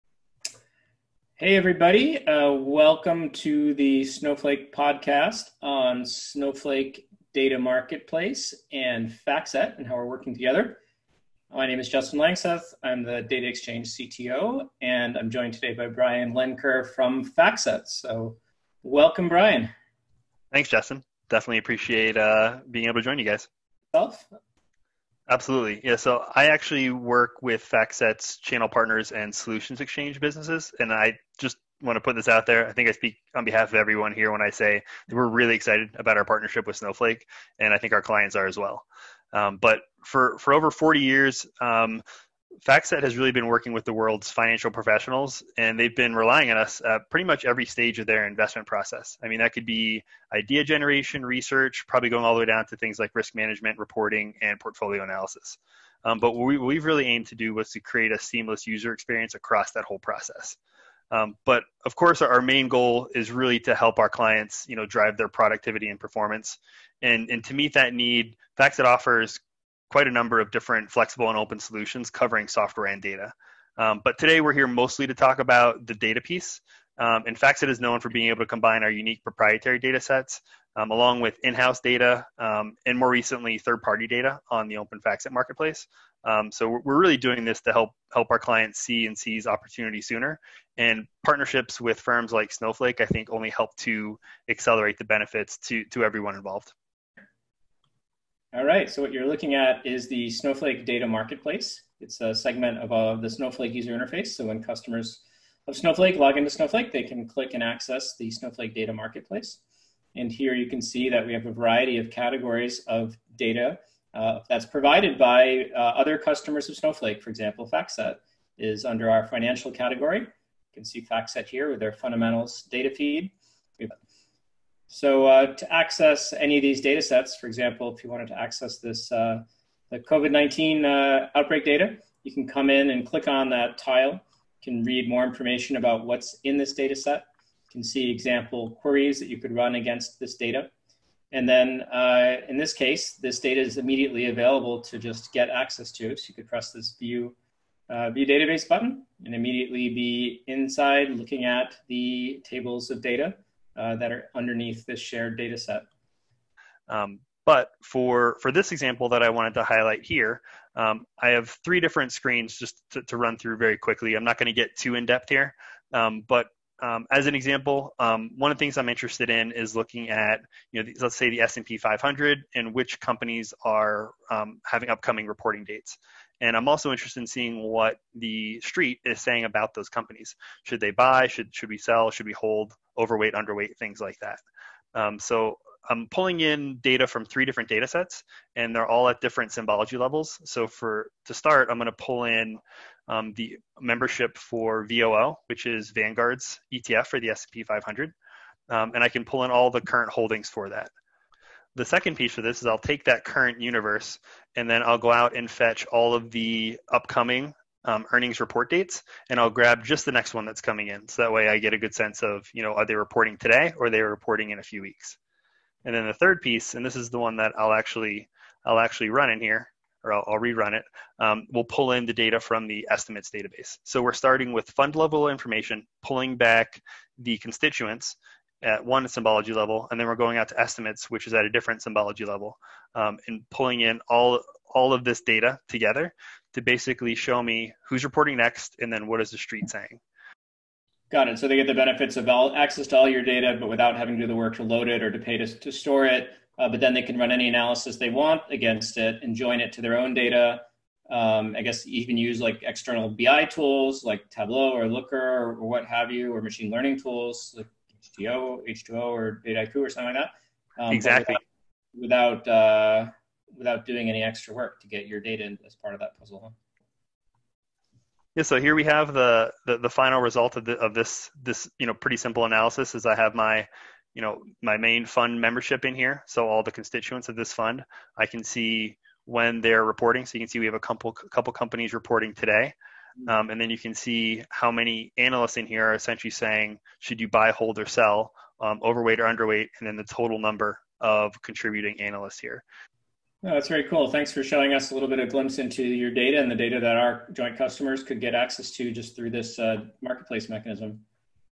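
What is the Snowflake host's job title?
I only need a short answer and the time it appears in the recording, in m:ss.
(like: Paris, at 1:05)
Data Exchange CTO, at 0:13.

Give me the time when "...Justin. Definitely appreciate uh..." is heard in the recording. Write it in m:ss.
0:20.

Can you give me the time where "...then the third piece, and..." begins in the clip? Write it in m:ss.
3:35.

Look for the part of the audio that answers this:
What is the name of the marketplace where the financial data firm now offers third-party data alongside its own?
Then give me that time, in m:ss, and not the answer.
1:24.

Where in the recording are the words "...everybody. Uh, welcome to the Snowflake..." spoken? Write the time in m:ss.
0:01.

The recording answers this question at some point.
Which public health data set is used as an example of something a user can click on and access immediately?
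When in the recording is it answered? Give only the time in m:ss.
2:09.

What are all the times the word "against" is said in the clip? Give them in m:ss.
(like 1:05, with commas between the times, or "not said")
2:19, 4:08.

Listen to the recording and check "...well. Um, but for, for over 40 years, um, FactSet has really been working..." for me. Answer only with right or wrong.
right.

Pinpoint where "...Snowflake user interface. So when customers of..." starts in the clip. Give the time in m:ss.
1:43.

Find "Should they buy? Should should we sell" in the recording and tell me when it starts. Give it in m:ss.
3:00.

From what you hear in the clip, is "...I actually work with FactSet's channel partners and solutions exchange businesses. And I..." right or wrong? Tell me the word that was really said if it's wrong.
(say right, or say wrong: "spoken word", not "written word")
right.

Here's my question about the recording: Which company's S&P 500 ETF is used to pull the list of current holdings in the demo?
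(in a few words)
Vanguard.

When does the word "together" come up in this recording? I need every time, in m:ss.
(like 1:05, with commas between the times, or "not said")
0:10, 3:55.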